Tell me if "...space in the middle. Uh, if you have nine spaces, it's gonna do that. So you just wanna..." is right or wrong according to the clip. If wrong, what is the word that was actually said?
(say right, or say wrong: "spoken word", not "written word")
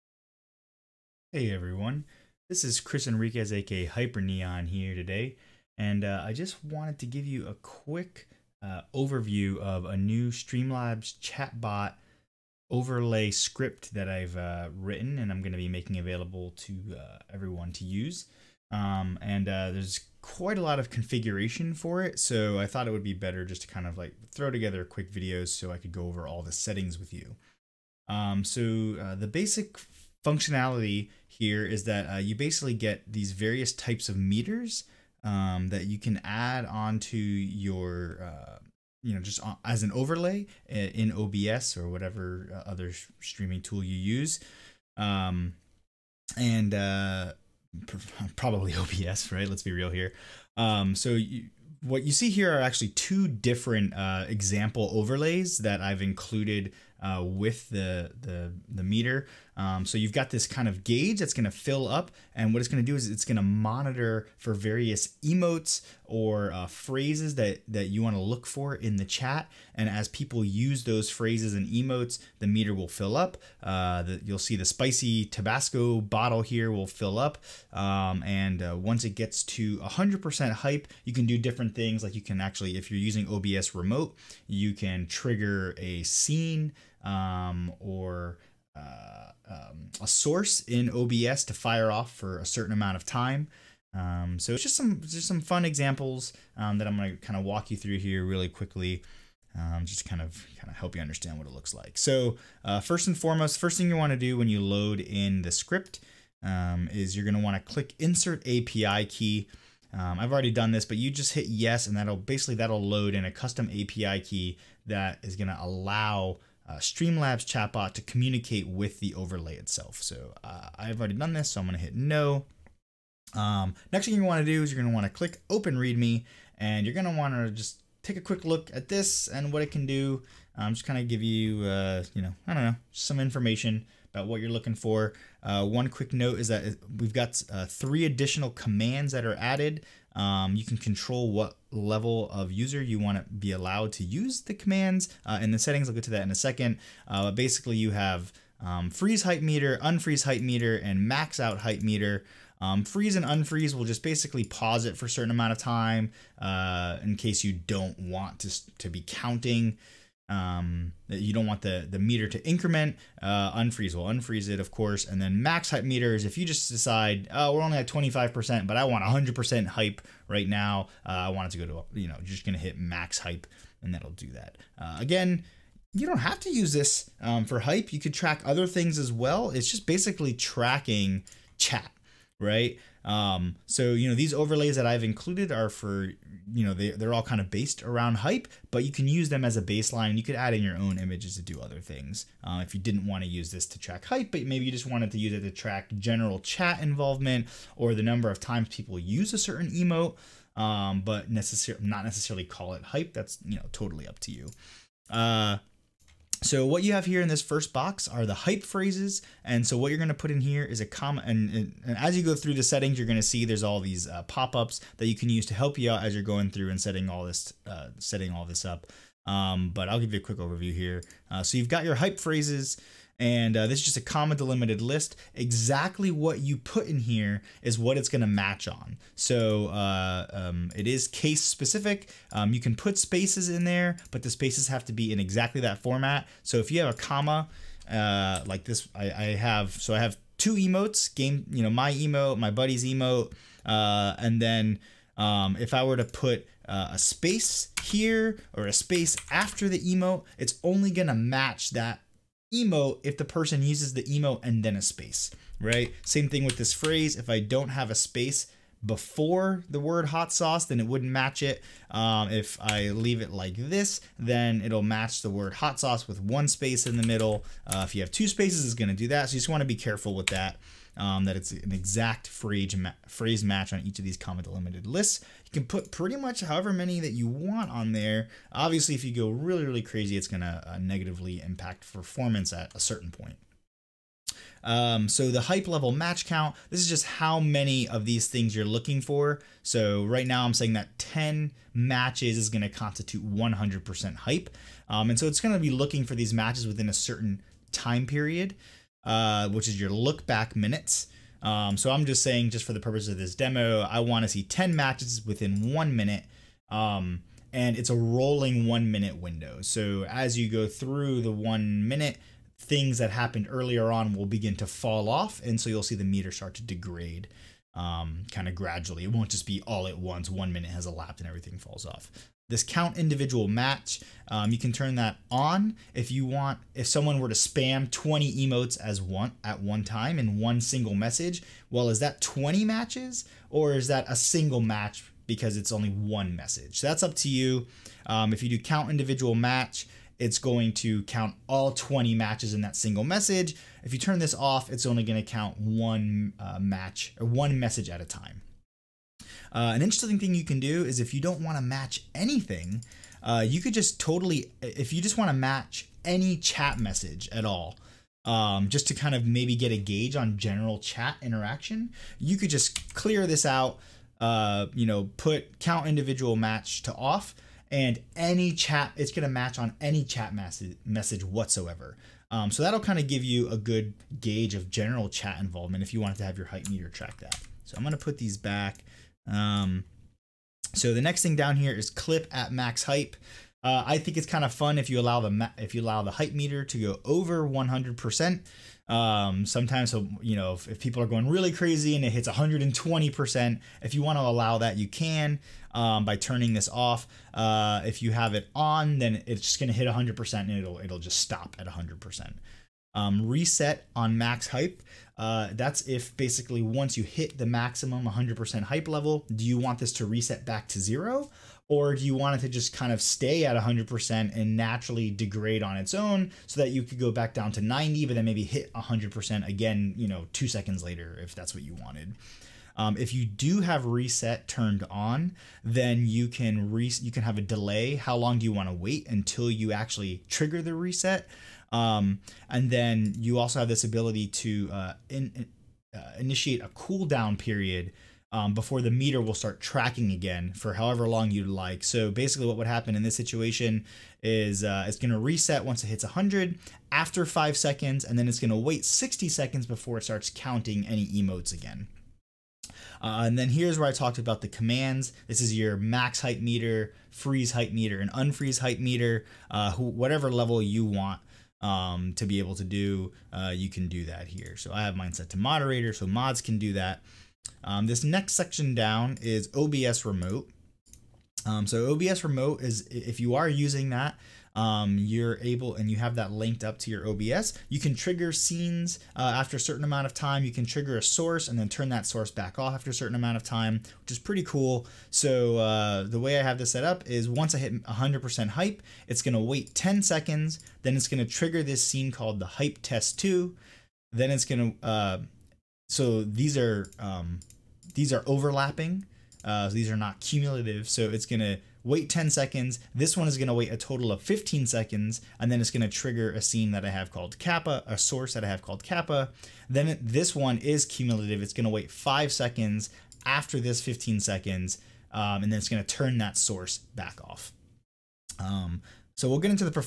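wrong: "two", not "nine".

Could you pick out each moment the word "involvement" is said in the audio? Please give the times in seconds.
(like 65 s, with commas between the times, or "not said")
196 s, 375 s.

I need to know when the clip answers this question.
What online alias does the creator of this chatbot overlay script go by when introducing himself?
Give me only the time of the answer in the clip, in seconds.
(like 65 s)
3 s.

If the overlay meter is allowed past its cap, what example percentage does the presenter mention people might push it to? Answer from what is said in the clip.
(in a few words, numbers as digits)
120%.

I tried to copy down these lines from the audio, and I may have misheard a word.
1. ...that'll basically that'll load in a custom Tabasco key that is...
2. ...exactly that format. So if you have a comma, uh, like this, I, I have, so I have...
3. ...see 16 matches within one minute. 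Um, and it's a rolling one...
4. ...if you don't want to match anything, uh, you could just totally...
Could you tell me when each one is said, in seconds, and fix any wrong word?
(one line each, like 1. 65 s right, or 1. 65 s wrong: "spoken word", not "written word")
1. 111 s wrong: "API", not "Tabasco"
2. 235 s right
3. 304 s wrong: "10", not "16"
4. 350 s right.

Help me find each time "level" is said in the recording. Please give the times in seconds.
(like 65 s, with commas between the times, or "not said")
141 s, 285 s, 408 s, 460 s.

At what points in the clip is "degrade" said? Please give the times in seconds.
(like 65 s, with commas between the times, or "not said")
316 s, 415 s.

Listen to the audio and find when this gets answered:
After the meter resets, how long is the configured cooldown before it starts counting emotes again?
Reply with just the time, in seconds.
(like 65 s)
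448 s.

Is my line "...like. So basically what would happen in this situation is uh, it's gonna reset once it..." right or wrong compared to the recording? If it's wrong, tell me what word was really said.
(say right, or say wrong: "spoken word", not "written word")
right.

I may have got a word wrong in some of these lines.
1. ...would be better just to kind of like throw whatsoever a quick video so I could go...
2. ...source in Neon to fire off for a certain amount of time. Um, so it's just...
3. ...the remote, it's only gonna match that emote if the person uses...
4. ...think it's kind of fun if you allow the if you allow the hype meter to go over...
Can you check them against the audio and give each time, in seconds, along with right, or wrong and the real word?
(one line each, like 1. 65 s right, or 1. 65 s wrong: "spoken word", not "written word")
1. 22 s wrong: "together", not "whatsoever"
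2. 90 s wrong: "OBS", not "Neon"
3. 249 s wrong: "emote", not "remote"
4. 383 s right.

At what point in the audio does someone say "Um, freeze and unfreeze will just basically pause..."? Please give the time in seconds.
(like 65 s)
152 s.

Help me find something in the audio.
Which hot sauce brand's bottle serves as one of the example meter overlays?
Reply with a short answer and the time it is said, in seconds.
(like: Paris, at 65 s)
Tabasco, at 75 s.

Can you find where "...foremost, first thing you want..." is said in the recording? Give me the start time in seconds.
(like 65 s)
103 s.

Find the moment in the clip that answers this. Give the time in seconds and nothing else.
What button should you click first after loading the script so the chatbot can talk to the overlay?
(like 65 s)
107 s.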